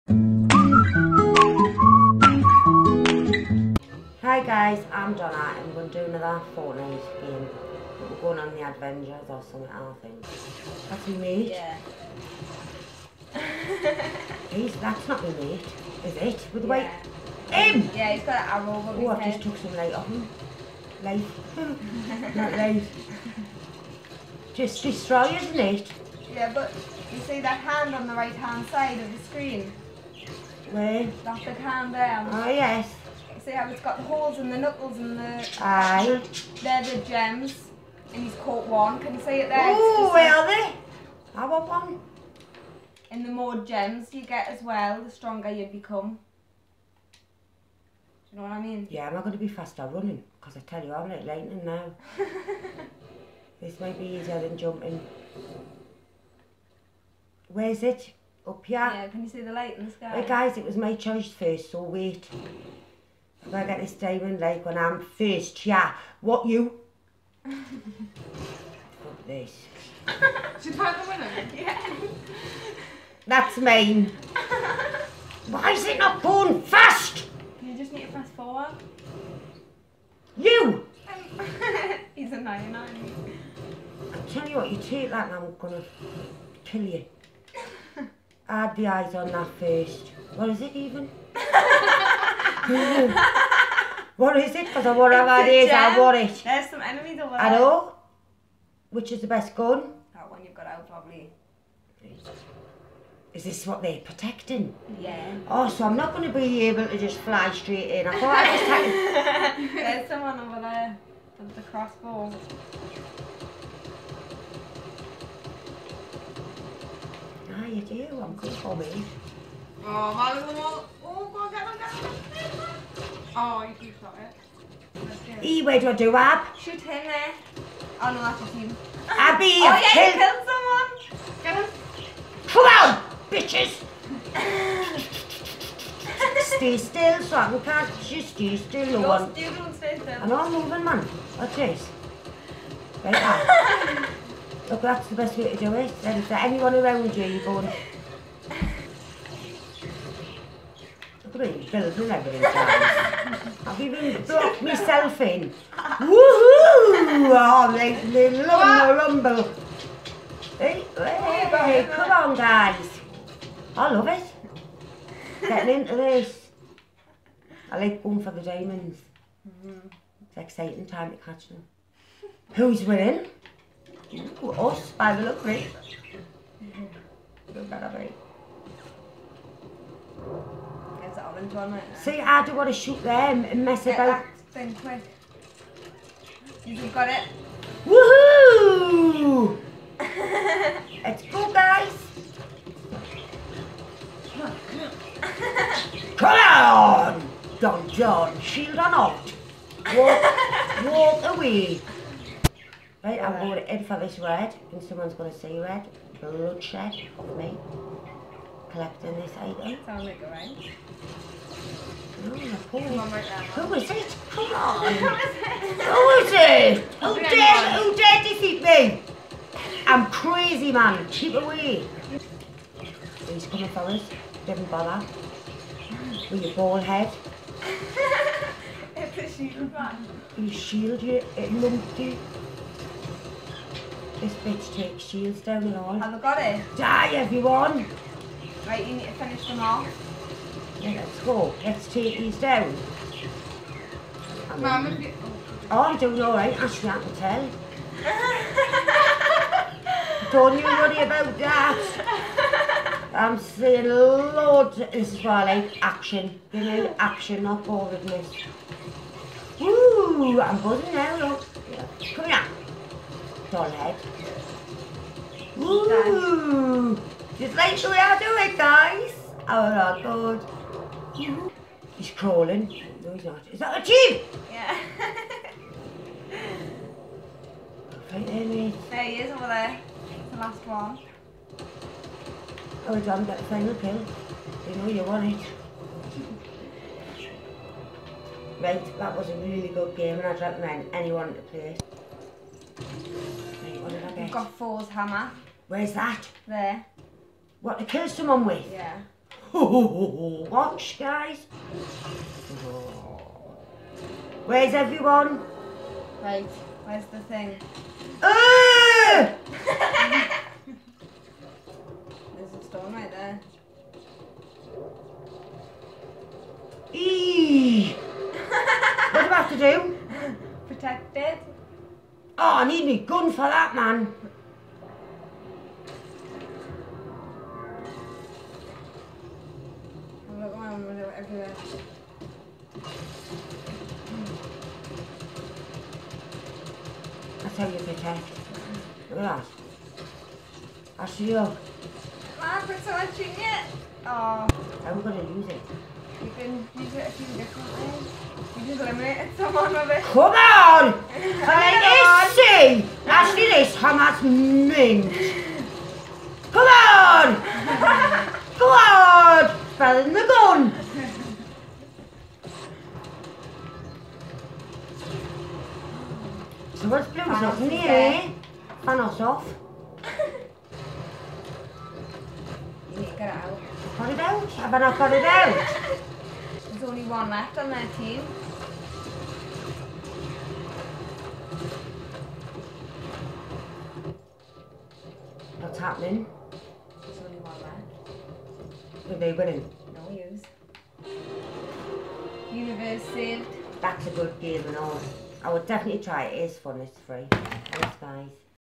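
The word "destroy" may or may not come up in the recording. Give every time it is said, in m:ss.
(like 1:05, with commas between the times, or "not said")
0:24.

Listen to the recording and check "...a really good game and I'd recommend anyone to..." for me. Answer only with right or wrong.
right.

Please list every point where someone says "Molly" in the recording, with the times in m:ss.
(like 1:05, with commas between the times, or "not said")
2:00.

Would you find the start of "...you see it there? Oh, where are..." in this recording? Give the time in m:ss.
0:39.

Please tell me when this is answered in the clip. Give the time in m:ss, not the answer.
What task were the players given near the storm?
5:20.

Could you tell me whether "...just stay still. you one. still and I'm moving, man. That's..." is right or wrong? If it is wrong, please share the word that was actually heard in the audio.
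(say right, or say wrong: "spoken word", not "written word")
right.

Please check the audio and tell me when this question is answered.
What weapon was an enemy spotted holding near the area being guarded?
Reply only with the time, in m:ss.
1:51.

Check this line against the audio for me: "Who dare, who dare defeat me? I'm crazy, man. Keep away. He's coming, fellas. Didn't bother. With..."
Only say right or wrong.
right.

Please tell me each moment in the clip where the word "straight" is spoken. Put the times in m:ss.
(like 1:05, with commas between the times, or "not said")
1:47.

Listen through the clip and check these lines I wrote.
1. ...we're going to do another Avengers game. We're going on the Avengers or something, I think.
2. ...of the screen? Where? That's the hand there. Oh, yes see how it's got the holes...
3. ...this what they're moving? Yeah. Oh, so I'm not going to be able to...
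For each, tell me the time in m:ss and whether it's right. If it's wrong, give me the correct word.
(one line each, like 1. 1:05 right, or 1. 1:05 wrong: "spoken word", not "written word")
1. 0:05 wrong: "Fortnite", not "Avengers"
2. 0:28 right
3. 1:43 wrong: "protecting", not "moving".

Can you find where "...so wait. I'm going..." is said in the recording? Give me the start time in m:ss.
1:01.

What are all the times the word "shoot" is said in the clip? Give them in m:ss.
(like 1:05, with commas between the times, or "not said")
2:06, 3:02.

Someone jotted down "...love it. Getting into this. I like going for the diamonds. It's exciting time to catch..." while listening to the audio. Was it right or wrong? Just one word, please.
right.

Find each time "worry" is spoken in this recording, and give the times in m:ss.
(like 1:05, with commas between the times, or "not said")
4:10.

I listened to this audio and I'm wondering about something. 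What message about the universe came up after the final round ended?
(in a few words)
Universe saved.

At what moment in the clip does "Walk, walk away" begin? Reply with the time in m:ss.
3:19.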